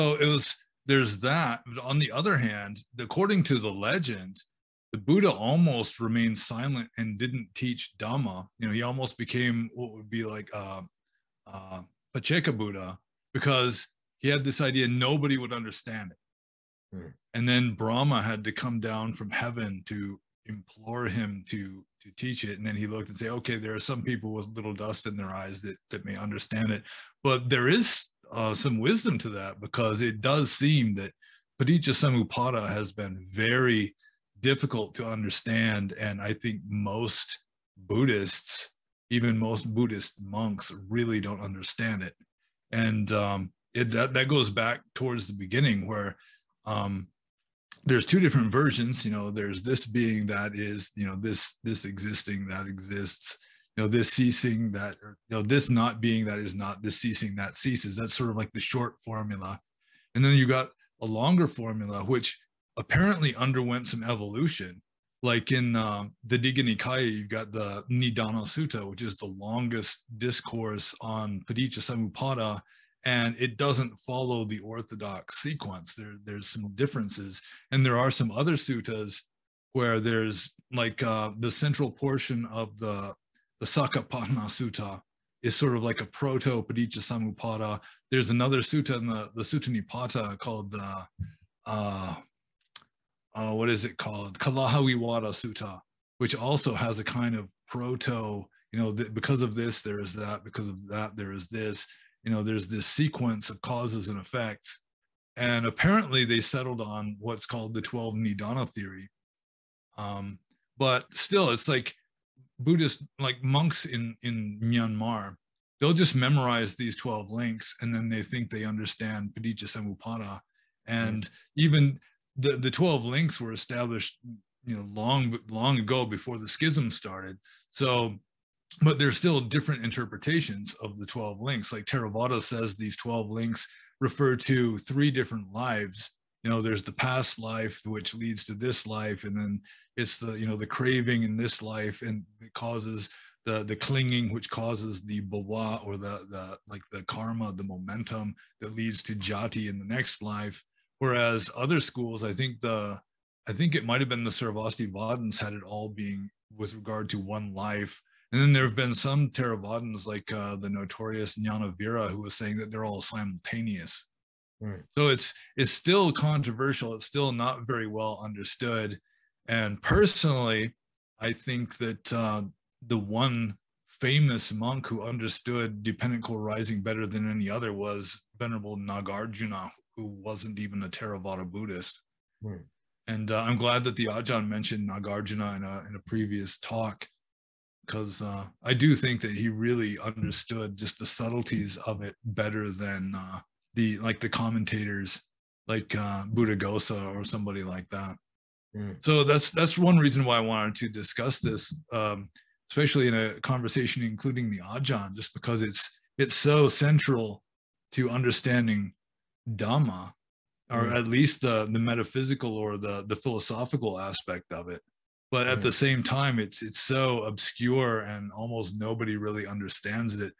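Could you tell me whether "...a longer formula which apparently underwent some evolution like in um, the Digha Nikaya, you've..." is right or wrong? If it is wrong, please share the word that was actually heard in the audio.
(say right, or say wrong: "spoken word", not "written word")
right.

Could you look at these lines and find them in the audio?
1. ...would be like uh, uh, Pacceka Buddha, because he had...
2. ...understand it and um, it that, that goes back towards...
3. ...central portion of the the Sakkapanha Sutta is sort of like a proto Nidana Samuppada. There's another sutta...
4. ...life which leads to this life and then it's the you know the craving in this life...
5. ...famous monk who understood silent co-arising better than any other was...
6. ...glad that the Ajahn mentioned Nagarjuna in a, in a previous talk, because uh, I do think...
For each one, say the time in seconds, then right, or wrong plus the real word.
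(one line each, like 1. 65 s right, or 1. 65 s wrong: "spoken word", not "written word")
1. 9 s right
2. 41 s right
3. 81 s wrong: "Paticca", not "Nidana"
4. 137 s right
5. 173 s wrong: "dependent", not "silent"
6. 183 s right.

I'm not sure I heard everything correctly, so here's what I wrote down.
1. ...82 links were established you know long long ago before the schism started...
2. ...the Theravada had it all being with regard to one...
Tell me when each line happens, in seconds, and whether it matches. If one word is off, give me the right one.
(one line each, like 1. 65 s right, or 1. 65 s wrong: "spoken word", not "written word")
1. 122 s wrong: "12", not "82"
2. 154 s wrong: "Sarvastivadins", not "Theravada".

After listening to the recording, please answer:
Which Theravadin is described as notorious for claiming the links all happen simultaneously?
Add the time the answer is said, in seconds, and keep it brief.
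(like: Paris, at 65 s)
Jnanavira, at 161 s.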